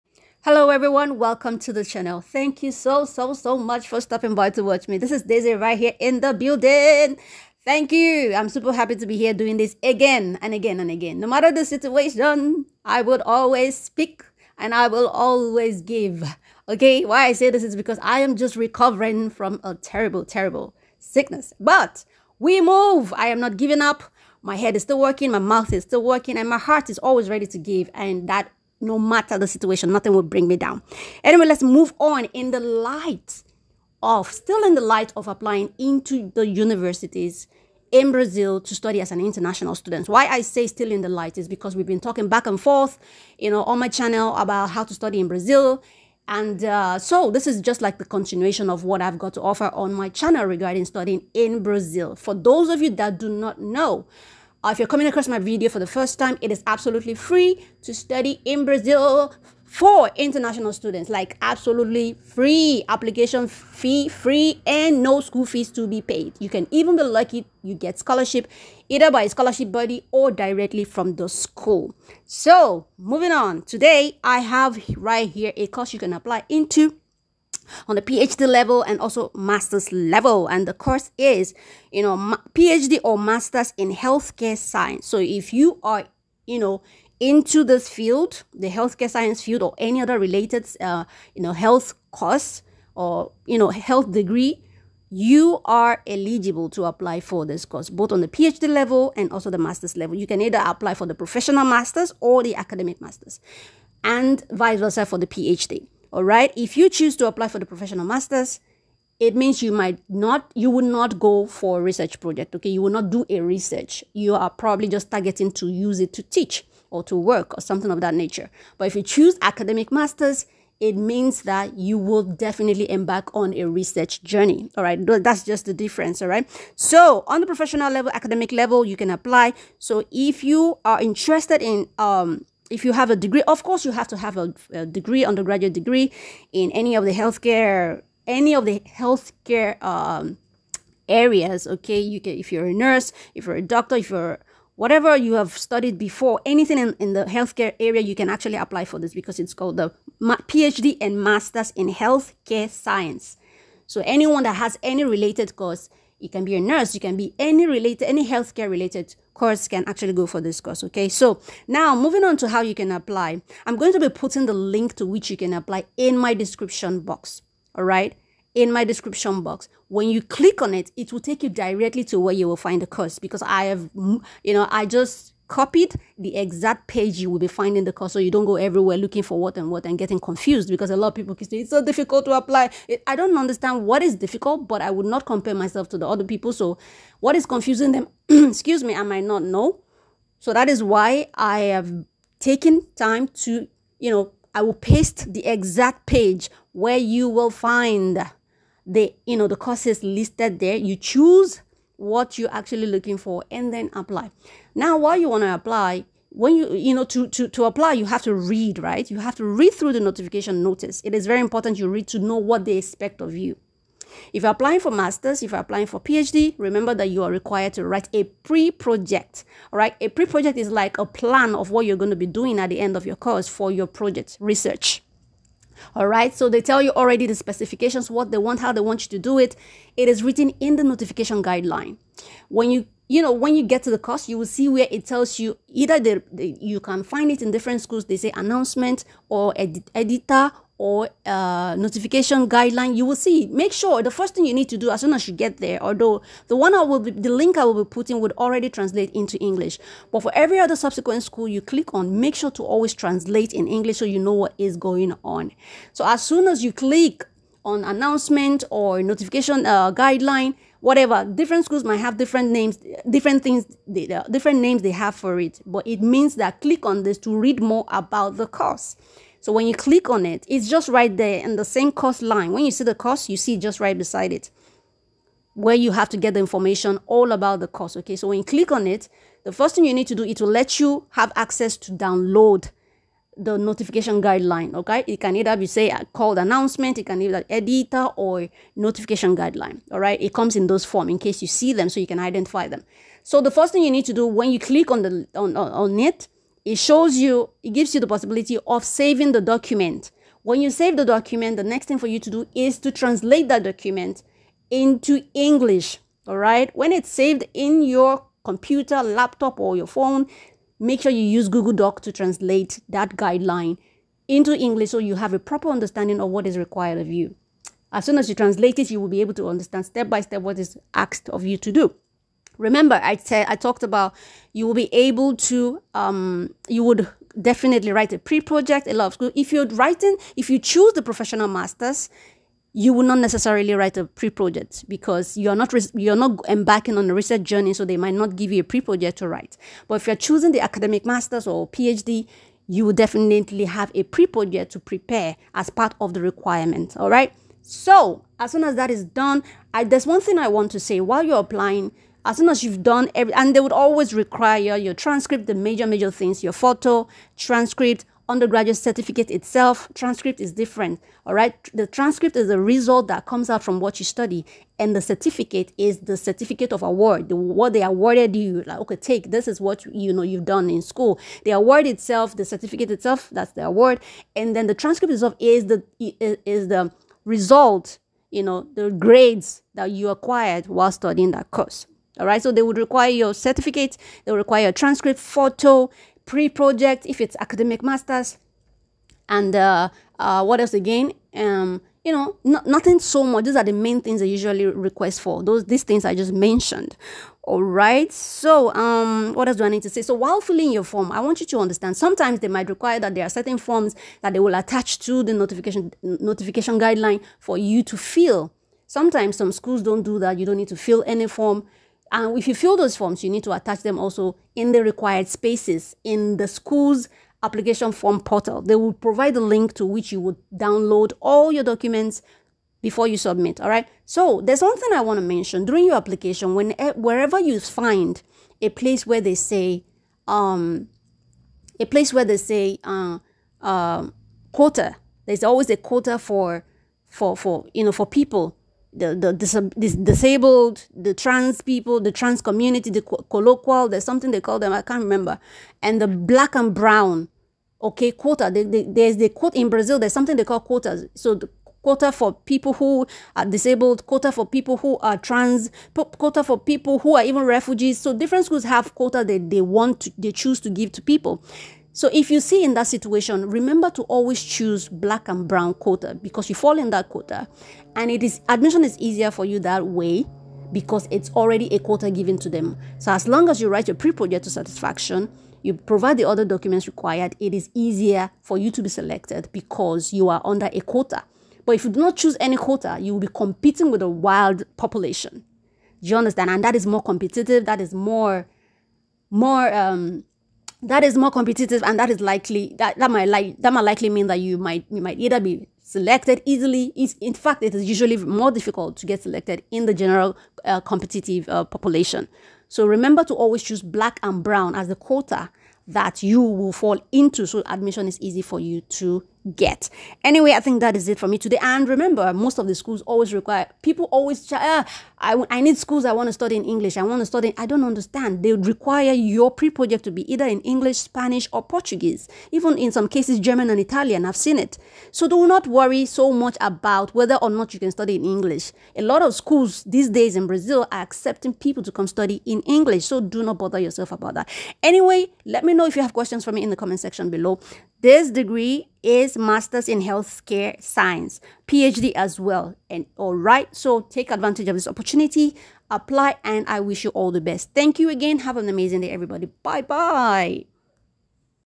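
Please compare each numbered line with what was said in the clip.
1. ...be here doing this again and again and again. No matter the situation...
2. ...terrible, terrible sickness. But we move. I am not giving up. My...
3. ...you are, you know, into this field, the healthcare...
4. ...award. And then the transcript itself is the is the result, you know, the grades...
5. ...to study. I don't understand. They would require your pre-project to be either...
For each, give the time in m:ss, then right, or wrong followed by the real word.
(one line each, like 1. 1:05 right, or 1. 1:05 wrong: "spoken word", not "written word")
1. 0:09 right
2. 0:19 right
3. 1:25 right
4. 6:13 right
5. 8:37 right.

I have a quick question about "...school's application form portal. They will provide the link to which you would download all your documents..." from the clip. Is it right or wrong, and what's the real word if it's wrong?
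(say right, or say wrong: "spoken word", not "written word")
right.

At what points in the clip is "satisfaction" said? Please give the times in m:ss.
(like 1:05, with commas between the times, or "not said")
7:54.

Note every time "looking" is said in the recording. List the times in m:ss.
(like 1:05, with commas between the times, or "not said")
2:58, 3:22.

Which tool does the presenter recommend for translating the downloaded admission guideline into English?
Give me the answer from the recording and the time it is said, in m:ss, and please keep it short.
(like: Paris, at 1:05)
Google Doc, at 5:11.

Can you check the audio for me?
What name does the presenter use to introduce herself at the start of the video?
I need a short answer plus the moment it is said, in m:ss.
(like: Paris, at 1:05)
Daezy, at 0:05.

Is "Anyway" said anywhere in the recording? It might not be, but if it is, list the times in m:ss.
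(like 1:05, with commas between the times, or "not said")
0:31, 8:30, 8:54.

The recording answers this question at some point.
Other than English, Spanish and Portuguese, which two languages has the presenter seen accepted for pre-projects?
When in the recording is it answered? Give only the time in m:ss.
8:43.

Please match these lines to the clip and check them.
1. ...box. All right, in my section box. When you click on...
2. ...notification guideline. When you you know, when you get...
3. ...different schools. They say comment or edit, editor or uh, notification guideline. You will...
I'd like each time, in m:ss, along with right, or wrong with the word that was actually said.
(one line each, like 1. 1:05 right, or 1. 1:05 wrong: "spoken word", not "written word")
1. 2:46 wrong: "description", not "section"
2. 3:50 right
3. 3:57 wrong: "announcement", not "comment".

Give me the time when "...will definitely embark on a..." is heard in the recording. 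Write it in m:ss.
2:01.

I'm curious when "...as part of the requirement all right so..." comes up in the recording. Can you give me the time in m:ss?
5:45.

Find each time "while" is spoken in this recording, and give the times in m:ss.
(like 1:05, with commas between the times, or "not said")
5:51, 6:20, 6:40.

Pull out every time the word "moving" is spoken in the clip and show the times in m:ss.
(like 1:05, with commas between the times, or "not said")
1:12, 2:41.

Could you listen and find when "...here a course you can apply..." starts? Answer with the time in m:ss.
1:15.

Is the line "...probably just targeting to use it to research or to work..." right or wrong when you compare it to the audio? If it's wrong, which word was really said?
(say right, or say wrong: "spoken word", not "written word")
wrong: "teach", not "research".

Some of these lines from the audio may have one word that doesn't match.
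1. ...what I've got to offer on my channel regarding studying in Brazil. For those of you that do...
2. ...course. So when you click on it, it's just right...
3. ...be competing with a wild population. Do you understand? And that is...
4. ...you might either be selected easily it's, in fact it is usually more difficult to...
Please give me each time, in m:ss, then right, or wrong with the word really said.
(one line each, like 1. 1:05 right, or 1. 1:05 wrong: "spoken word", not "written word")
1. 0:48 right
2. 4:28 right
3. 8:03 right
4. 8:14 right.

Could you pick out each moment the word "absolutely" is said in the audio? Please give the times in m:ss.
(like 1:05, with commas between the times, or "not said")
0:56, 1:01.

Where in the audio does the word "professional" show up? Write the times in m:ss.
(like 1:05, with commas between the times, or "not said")
1:41, 1:47, 2:07, 5:31.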